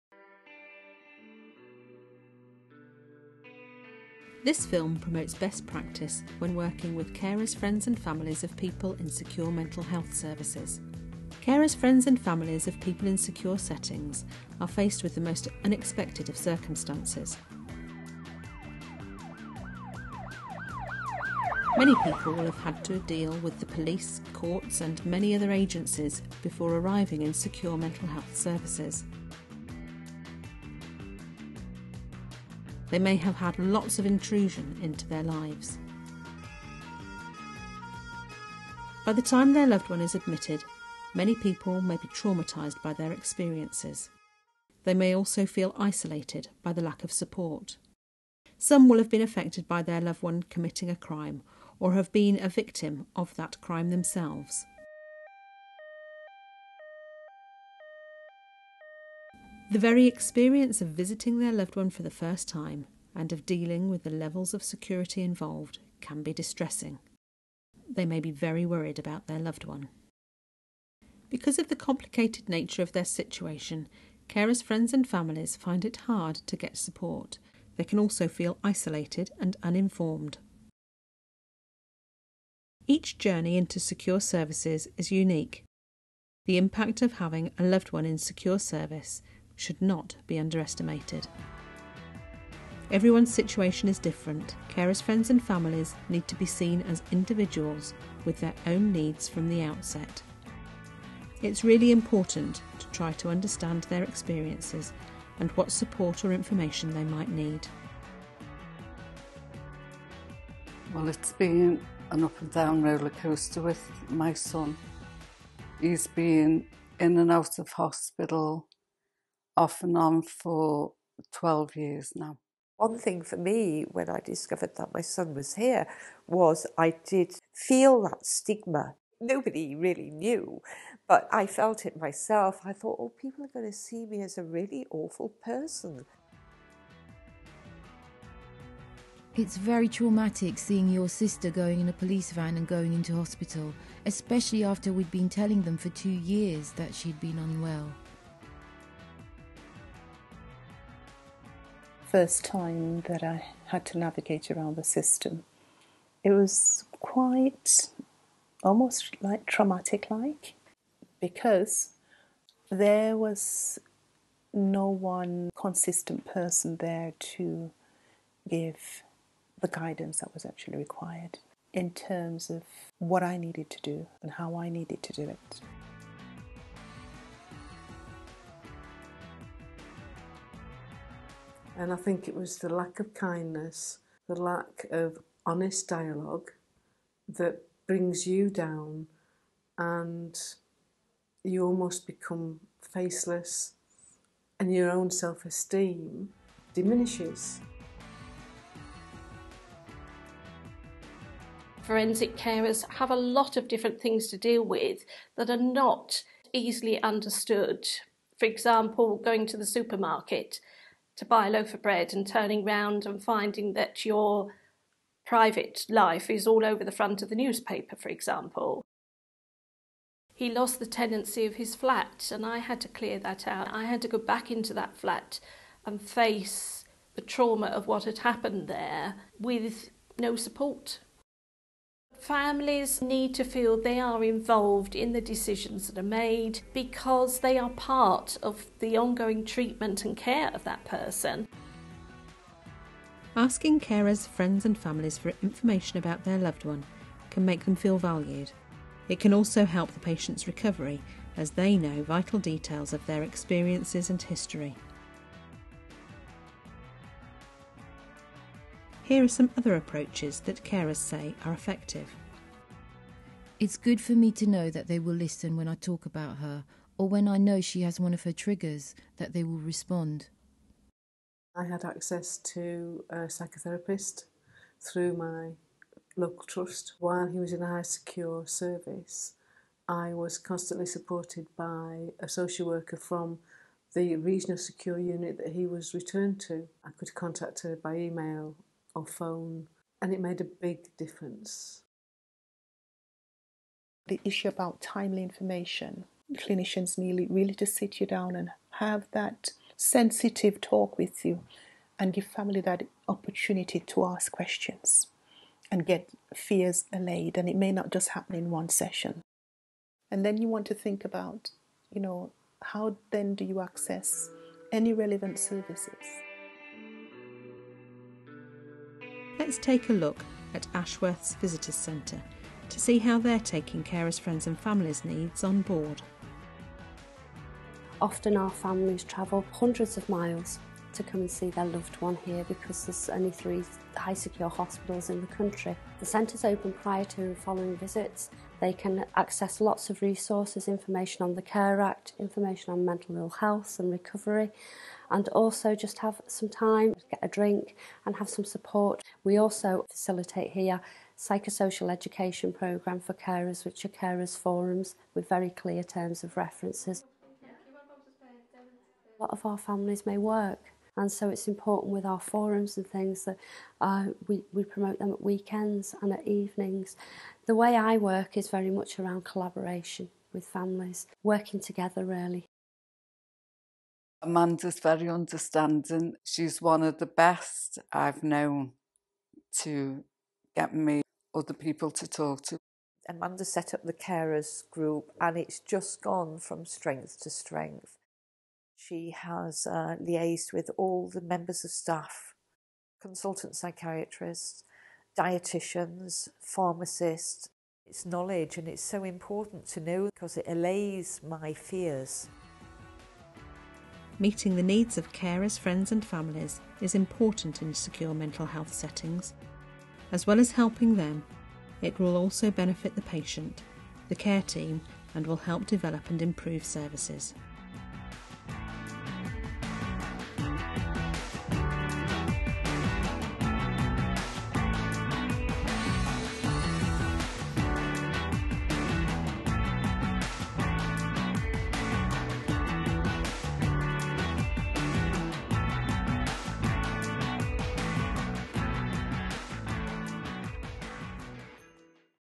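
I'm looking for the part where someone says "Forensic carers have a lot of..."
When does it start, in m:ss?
3:21.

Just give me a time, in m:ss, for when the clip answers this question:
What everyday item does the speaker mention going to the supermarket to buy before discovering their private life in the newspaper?
3:31.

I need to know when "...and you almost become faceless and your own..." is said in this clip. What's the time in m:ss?
3:09.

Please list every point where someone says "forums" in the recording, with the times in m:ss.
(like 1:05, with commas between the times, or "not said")
5:54, 6:02.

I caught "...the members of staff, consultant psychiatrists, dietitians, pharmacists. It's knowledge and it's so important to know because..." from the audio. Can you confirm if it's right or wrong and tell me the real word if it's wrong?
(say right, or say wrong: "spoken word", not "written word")
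right.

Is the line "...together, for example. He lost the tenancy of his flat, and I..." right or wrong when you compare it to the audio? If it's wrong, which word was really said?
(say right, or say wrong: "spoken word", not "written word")
wrong: "newspaper", not "together".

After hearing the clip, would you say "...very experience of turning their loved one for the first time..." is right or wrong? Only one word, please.
wrong.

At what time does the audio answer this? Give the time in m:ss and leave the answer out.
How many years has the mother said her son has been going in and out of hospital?
2:01.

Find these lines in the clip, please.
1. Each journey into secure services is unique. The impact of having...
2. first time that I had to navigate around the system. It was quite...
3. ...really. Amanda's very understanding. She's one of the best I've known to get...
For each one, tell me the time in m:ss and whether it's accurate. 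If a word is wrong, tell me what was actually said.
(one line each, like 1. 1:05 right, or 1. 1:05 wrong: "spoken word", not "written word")
1. 1:22 right
2. 2:32 right
3. 6:12 right.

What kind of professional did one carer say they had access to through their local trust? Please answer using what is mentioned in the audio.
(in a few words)
psychotherapist.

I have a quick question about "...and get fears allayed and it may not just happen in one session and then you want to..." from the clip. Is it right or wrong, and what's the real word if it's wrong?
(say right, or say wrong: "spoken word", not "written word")
right.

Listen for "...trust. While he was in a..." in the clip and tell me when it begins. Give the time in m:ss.
4:36.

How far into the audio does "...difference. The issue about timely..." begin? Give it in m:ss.
4:50.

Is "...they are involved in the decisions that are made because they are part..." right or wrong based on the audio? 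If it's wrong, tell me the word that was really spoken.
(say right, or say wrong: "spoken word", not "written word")
right.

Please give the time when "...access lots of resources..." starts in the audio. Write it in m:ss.
5:39.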